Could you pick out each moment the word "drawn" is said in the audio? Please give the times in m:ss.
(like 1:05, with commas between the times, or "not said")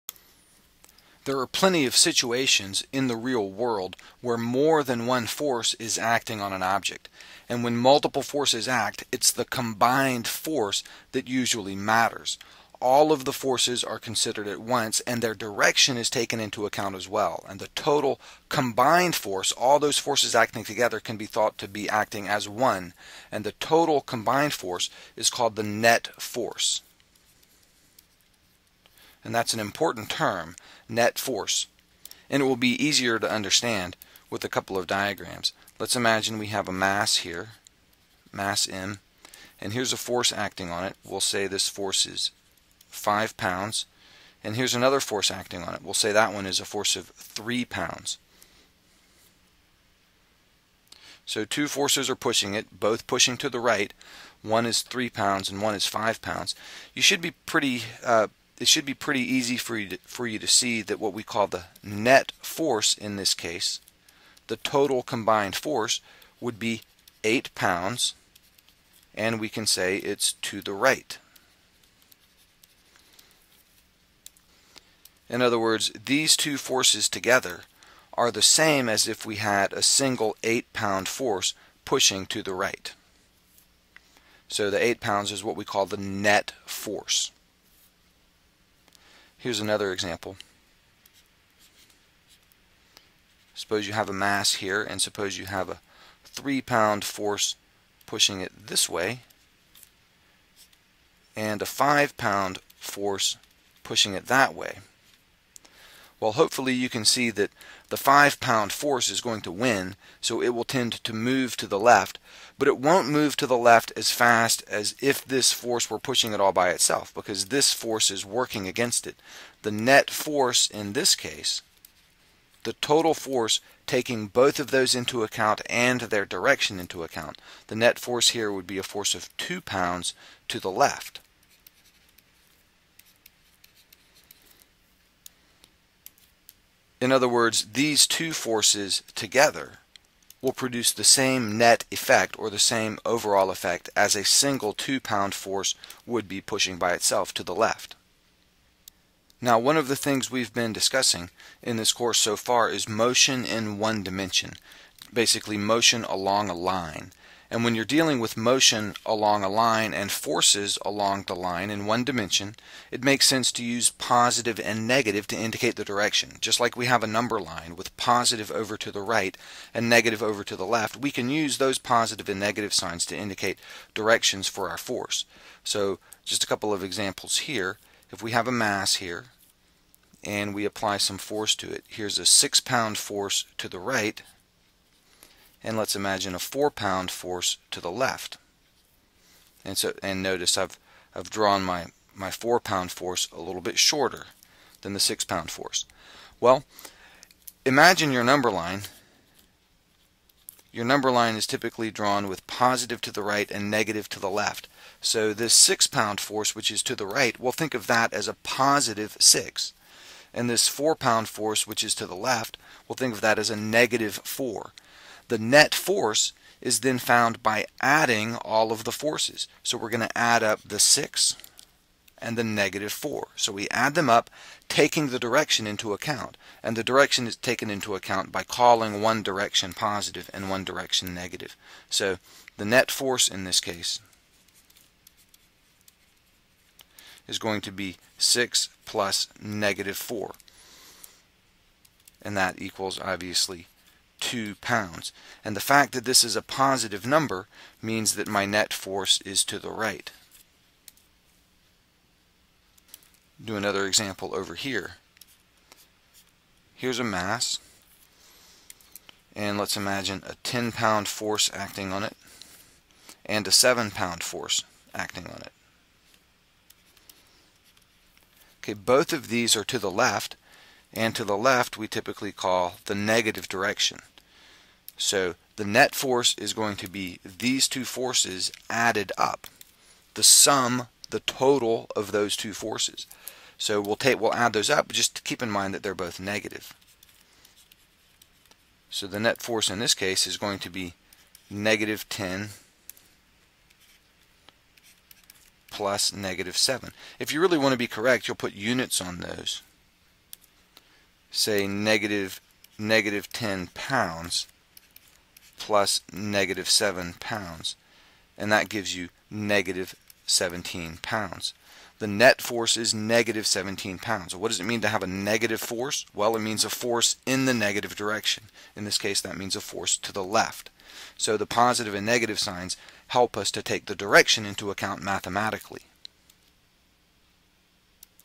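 3:11, 3:21.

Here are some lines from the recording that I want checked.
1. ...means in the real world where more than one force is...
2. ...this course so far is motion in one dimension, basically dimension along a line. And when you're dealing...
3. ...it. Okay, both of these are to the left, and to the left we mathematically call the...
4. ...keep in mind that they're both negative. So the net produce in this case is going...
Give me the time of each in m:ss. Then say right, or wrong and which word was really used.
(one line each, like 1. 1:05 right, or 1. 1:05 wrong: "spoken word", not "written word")
1. 0:01 wrong: "situations", not "means"
2. 2:31 wrong: "motion", not "dimension"
3. 4:25 wrong: "typically", not "mathematically"
4. 4:45 wrong: "force", not "produce".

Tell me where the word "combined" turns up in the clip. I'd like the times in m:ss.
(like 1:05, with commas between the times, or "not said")
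0:09, 0:18, 0:24, 1:05.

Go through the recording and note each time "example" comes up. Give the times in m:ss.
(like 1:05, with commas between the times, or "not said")
1:29, 2:56, 4:13.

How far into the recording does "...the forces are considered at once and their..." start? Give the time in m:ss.
0:13.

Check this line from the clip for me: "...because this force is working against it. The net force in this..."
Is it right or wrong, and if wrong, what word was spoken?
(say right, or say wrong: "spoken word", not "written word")
right.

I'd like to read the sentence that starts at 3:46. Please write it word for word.
And the direction is taken into account by calling one direction positive and one direction negative.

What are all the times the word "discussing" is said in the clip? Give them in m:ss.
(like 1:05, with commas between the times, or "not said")
2:30.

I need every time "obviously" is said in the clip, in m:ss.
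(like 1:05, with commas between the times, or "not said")
4:02.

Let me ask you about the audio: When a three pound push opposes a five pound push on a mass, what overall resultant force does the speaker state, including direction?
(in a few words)
2 pounds to the left.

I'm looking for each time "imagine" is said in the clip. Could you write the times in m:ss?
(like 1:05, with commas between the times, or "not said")
0:35, 3:05, 3:17, 4:19.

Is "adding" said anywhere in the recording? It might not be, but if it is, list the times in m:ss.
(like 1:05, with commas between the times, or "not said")
3:37.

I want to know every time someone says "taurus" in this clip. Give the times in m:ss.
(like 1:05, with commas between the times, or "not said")
not said.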